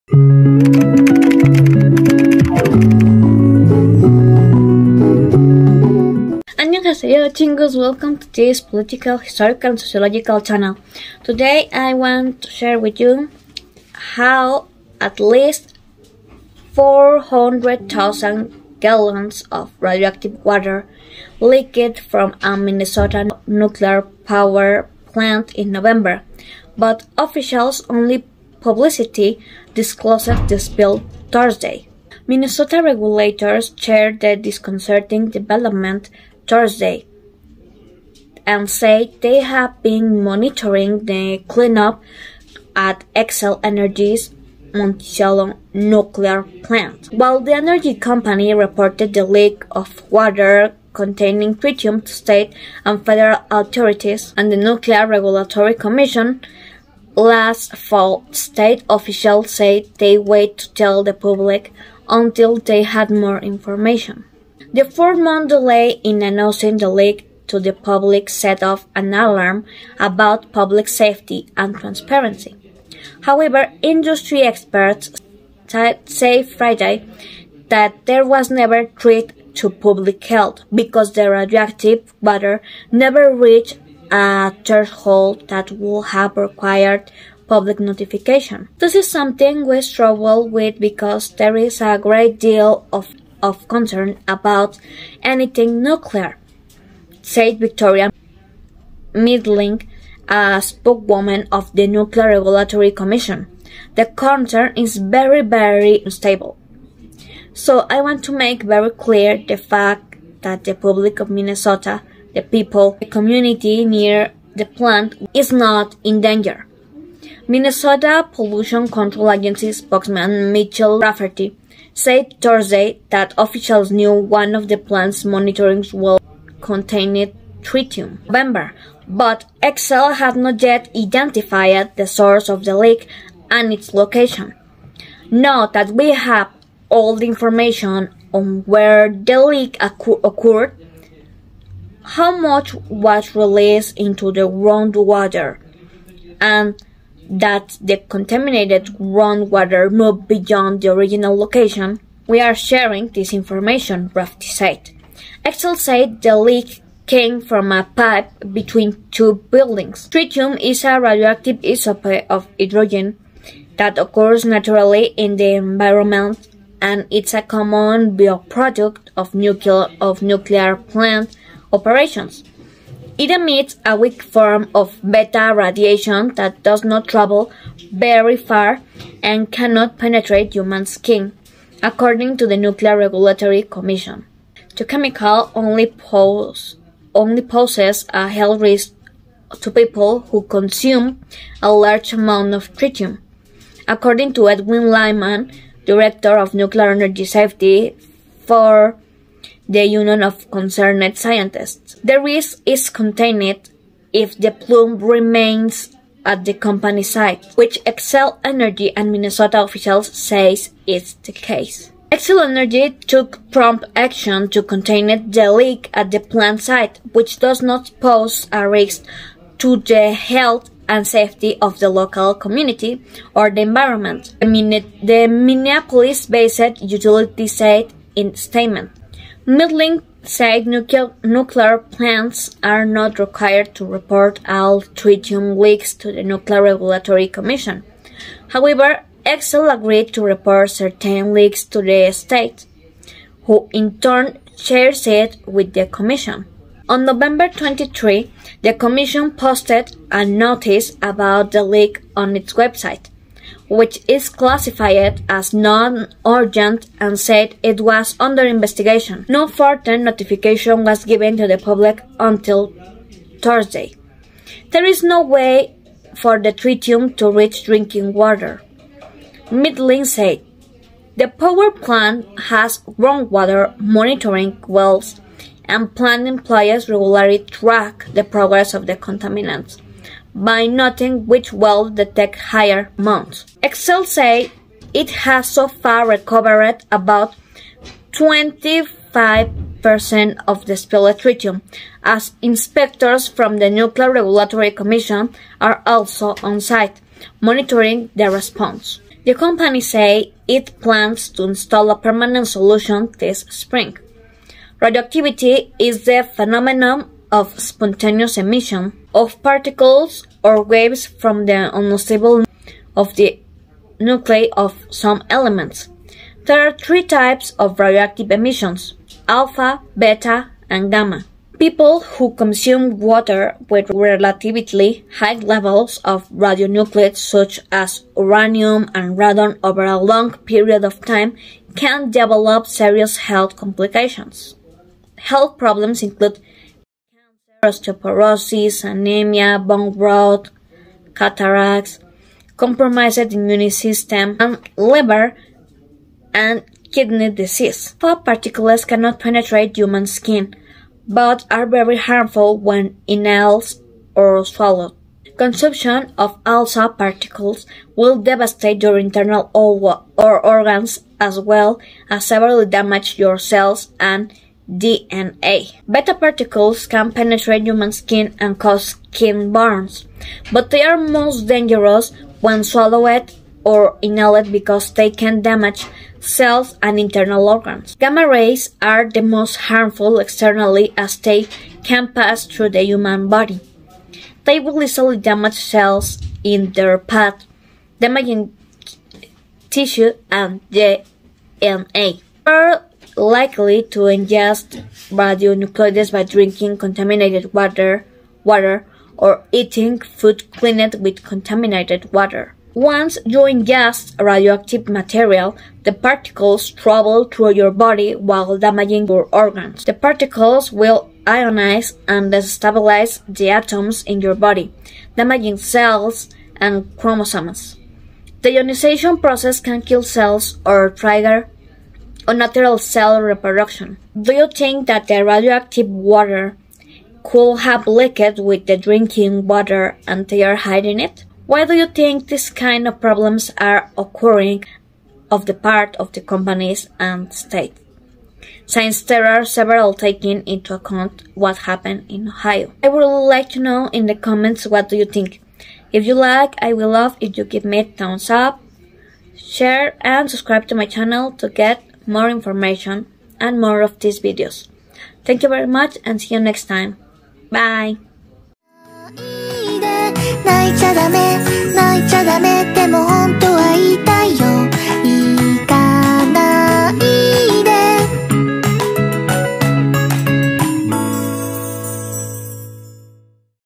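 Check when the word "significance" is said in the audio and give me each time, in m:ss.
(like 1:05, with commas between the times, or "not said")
not said.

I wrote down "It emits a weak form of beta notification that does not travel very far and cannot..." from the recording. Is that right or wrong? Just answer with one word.
wrong.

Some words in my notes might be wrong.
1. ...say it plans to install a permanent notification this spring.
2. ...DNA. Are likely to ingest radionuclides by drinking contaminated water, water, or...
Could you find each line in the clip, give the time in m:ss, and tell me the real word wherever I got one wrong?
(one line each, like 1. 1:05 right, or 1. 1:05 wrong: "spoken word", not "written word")
1. 4:59 wrong: "solution", not "notification"
2. 6:30 right.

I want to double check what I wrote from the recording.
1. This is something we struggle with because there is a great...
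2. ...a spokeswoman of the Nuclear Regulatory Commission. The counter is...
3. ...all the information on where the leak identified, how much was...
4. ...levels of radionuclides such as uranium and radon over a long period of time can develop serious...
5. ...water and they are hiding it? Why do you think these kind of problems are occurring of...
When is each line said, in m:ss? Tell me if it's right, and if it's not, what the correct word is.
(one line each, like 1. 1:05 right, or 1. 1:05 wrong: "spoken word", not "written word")
1. 1:28 right
2. 1:40 right
3. 2:16 wrong: "occurred", not "identified"
4. 5:25 right
5. 7:09 right.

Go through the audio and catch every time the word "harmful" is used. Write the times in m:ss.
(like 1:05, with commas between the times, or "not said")
5:51, 6:19.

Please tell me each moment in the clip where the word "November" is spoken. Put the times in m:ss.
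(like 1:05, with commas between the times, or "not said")
0:25, 2:08, 4:07.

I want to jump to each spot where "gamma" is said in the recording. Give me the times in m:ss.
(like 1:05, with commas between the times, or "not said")
5:20, 6:17.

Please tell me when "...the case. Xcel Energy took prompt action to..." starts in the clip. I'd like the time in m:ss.
3:31.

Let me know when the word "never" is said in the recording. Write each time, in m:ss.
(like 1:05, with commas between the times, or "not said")
1:18, 1:23.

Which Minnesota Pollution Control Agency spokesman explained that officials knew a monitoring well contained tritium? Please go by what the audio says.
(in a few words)
Mitchell Rafferty.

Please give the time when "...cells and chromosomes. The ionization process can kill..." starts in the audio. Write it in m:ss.
6:55.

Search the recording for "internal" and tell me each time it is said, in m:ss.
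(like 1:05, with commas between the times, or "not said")
5:58, 6:16.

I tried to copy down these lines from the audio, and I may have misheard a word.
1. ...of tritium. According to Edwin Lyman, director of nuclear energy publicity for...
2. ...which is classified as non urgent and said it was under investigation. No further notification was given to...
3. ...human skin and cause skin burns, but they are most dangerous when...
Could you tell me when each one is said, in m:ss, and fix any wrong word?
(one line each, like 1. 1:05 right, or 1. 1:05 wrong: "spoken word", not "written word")
1. 3:12 wrong: "safety", not "publicity"
2. 4:13 right
3. 6:07 right.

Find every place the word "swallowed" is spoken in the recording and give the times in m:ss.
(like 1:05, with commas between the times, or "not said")
5:54, 6:12.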